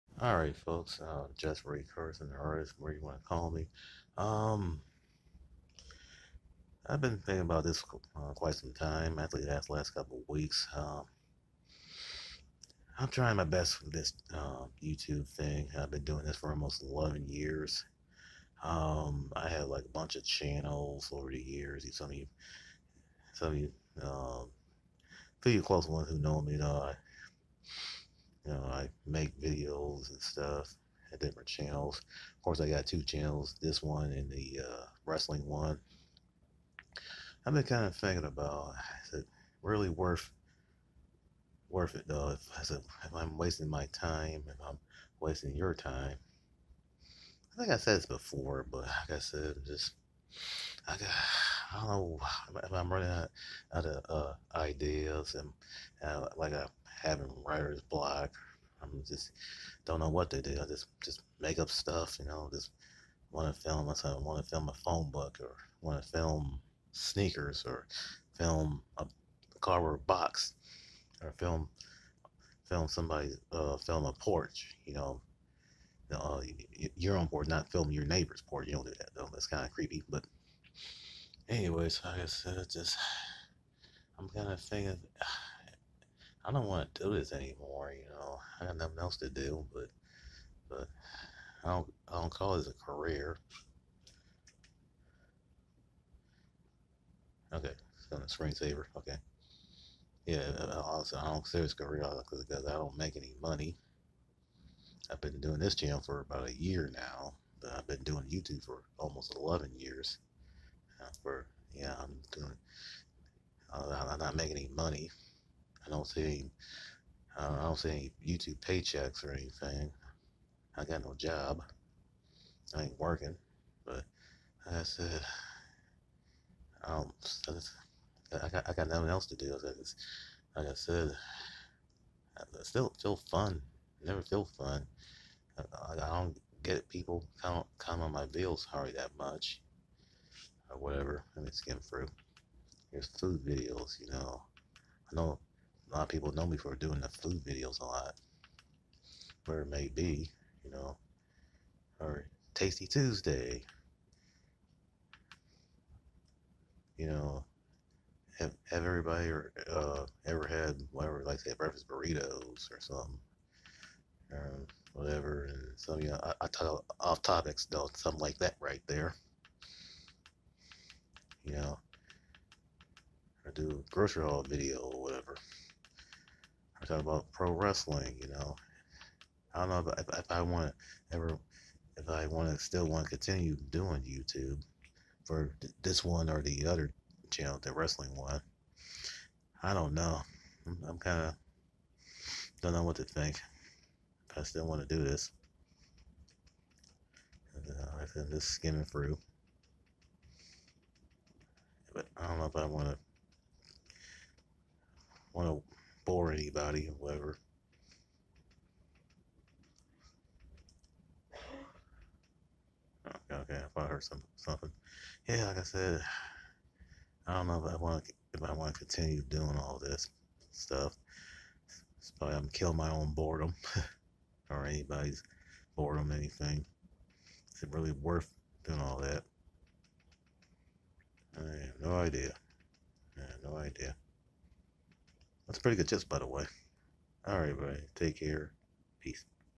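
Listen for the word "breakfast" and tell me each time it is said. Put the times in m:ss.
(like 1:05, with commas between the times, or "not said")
2:41.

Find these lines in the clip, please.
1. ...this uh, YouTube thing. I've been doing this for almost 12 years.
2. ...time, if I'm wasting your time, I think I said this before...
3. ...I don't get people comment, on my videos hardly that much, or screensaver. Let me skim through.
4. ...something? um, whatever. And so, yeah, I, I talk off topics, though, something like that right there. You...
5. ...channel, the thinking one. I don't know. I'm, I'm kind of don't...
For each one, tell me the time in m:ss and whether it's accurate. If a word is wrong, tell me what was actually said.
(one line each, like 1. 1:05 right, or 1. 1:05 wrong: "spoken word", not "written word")
1. 0:13 wrong: "11", not "12"
2. 0:43 right
3. 2:15 wrong: "whatever", not "screensaver"
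4. 2:42 right
5. 3:07 wrong: "wrestling", not "thinking".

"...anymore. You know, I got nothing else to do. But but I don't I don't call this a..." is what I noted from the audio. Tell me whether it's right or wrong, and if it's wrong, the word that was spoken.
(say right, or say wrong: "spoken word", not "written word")
right.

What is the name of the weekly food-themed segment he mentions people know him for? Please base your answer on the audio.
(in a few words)
Tasty Tuesday.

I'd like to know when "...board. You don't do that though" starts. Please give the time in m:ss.
1:18.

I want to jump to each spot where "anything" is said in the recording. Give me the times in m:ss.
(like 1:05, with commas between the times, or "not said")
1:59, 3:46.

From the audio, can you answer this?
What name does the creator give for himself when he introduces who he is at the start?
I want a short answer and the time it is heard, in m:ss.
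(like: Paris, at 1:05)
Ray Carson, at 0:01.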